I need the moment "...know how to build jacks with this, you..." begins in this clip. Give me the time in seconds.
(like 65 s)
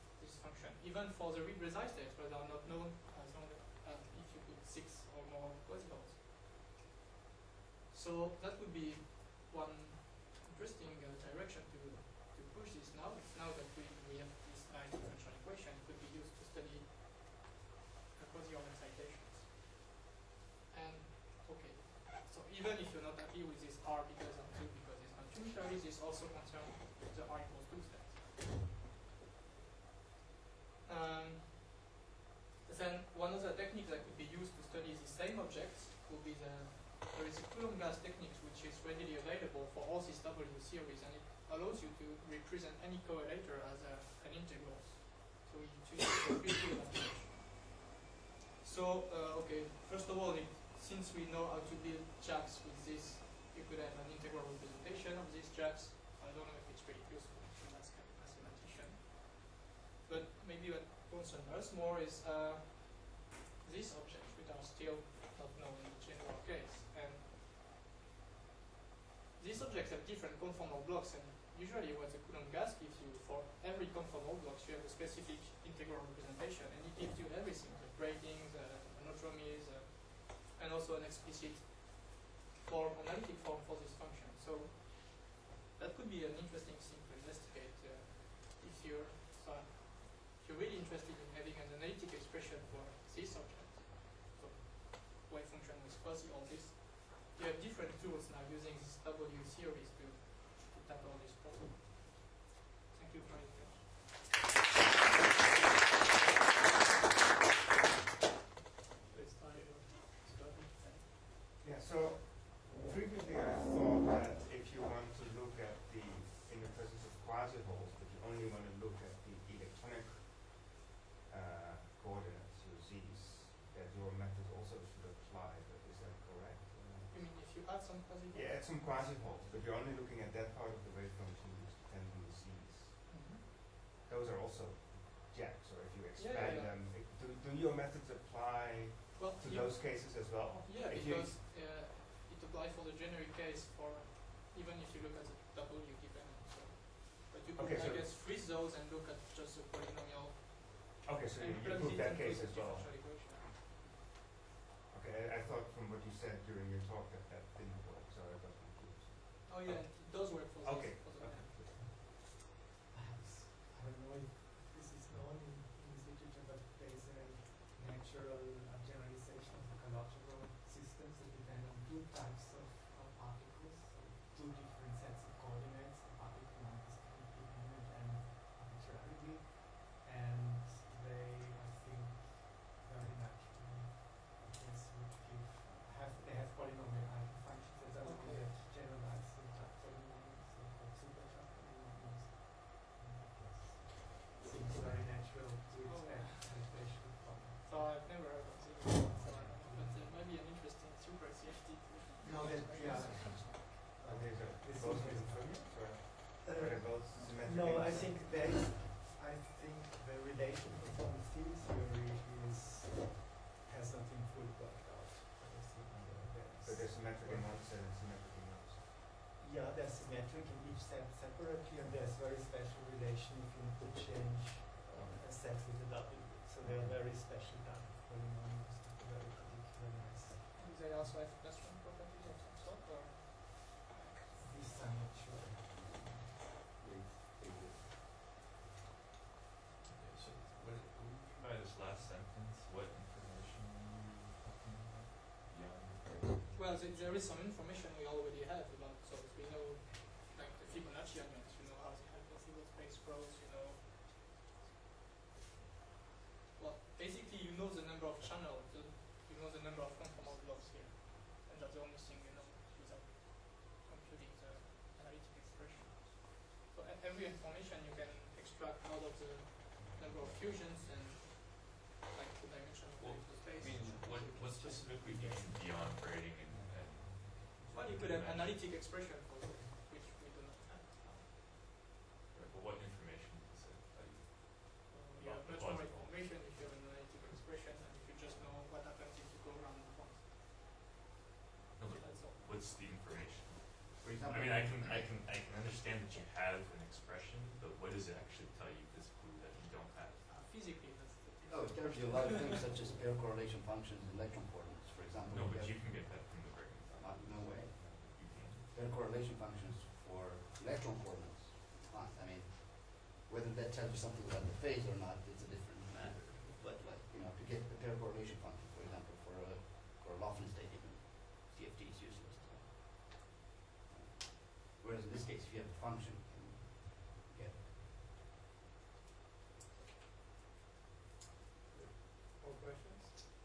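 51 s.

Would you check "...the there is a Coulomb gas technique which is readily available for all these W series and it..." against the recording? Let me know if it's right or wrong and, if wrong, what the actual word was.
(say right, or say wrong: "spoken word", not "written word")
right.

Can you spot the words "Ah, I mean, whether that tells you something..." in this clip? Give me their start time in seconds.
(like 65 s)
311 s.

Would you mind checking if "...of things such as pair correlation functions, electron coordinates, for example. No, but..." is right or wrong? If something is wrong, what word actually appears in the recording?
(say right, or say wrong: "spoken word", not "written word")
right.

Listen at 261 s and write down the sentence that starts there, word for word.
And that's the only thing you know without computing the analytic expression.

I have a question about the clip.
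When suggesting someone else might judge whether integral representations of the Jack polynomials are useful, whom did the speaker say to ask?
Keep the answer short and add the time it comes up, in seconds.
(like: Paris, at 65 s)
a mathematician, at 57 s.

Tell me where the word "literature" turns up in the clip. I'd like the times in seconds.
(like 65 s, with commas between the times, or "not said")
166 s.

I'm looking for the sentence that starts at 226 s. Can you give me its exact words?
So they are very special double polynomials, very particular nice.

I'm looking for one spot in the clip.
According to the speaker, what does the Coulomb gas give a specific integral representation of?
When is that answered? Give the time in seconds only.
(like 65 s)
73 s.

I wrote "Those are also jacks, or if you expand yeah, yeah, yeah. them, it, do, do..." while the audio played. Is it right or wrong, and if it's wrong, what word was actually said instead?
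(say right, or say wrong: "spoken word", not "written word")
right.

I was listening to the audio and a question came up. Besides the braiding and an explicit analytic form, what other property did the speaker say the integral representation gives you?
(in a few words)
the monodromies.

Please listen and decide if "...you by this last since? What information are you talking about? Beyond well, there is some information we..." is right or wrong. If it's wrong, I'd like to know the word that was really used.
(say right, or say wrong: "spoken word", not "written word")
wrong: "sentence", not "since".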